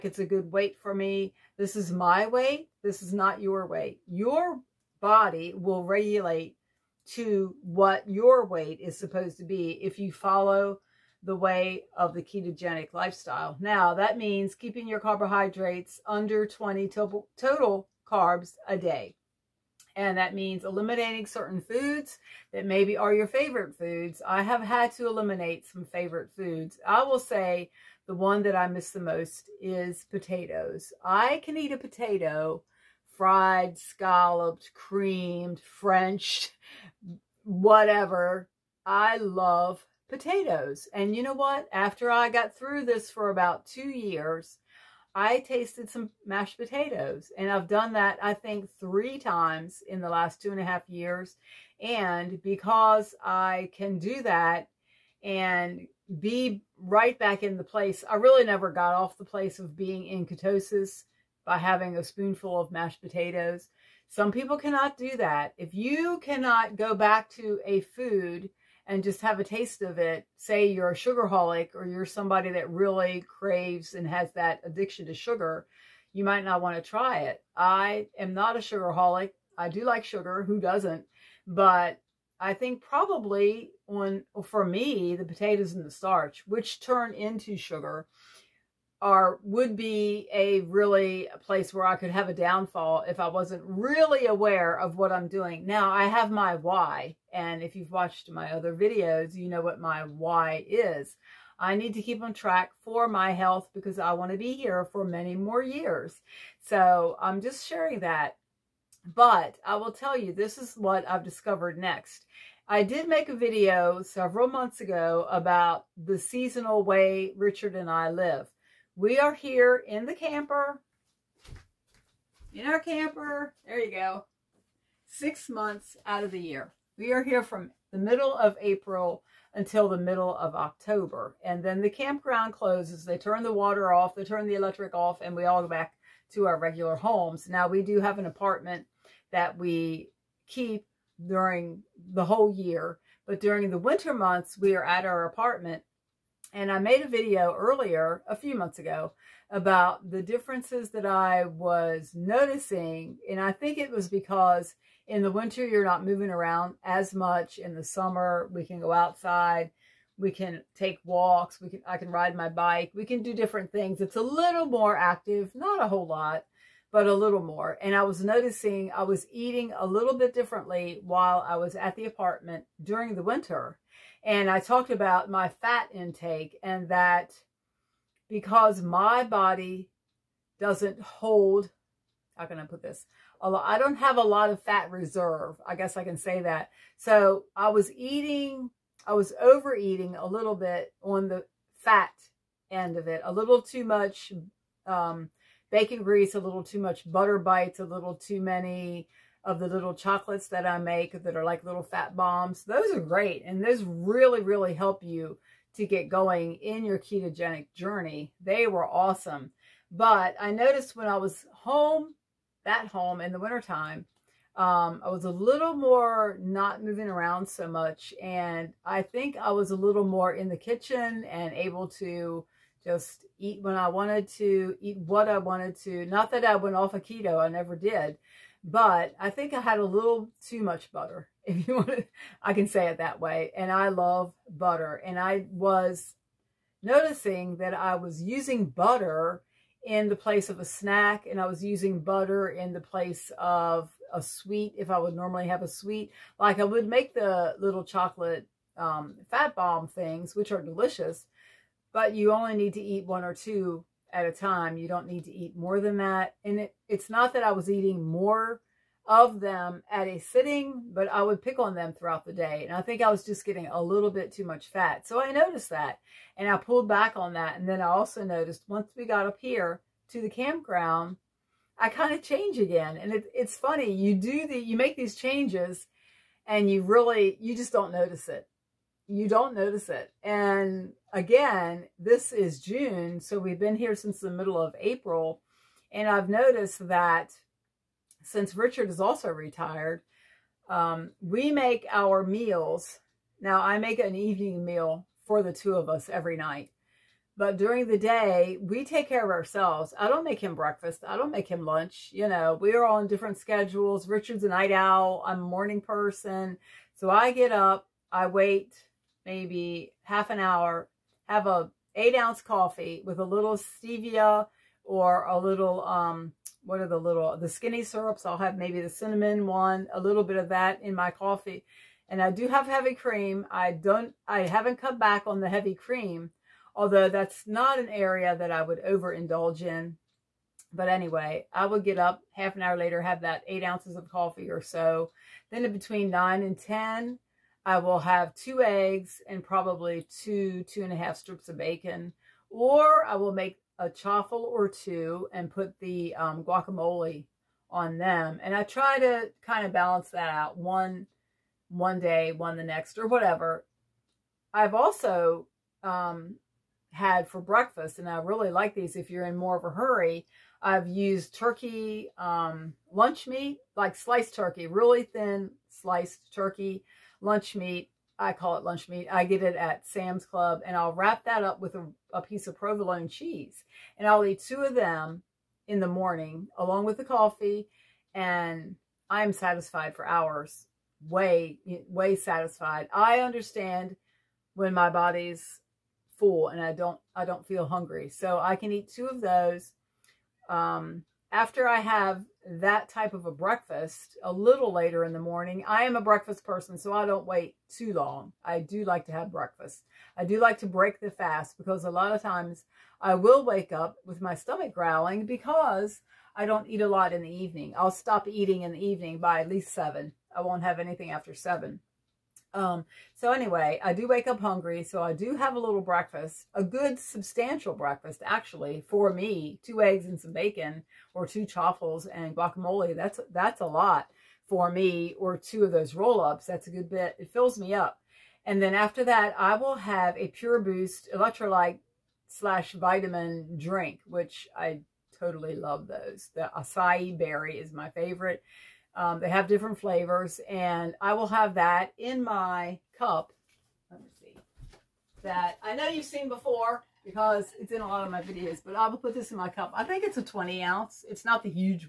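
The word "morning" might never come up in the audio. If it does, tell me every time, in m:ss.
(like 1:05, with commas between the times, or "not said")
5:05, 6:15, 6:35.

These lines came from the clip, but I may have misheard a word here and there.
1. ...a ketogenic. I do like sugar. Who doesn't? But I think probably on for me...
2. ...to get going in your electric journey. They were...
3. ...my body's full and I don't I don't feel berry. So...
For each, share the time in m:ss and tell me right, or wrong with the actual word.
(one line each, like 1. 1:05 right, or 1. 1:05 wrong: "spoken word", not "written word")
1. 1:18 wrong: "sugarholic", not "ketogenic"
2. 3:25 wrong: "ketogenic", not "electric"
3. 6:24 wrong: "hungry", not "berry".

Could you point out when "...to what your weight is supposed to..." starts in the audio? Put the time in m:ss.
0:07.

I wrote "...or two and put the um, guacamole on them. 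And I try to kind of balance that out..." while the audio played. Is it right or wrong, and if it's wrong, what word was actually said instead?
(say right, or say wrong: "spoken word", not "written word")
right.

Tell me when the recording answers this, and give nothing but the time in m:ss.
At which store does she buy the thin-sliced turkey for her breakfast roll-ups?
6:09.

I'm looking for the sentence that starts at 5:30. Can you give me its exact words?
But anyway, I would get up half an hour later, have that eight ounces of coffee or so.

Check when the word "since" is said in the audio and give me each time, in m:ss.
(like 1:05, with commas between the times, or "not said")
4:43, 4:48.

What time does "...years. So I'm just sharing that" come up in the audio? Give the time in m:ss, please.
1:45.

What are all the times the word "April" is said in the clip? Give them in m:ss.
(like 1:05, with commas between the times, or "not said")
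2:08, 4:44.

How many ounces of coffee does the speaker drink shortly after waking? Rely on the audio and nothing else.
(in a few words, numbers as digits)
8.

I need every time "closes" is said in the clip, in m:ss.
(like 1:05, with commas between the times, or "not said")
2:12.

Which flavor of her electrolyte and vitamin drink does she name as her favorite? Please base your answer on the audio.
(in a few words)
acai berry.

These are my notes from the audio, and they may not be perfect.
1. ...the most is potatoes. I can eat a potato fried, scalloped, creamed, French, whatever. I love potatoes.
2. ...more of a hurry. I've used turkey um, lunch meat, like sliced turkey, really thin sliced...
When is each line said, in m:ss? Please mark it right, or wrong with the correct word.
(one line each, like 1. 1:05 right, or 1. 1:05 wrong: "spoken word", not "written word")
1. 0:28 right
2. 5:59 right.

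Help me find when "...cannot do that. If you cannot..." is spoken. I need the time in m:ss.
1:04.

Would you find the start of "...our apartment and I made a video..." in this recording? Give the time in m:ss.
2:25.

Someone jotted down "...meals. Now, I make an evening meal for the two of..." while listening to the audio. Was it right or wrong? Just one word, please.
right.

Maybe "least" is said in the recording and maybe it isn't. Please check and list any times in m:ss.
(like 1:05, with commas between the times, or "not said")
6:49.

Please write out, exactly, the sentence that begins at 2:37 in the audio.
In the summer, we can go outside.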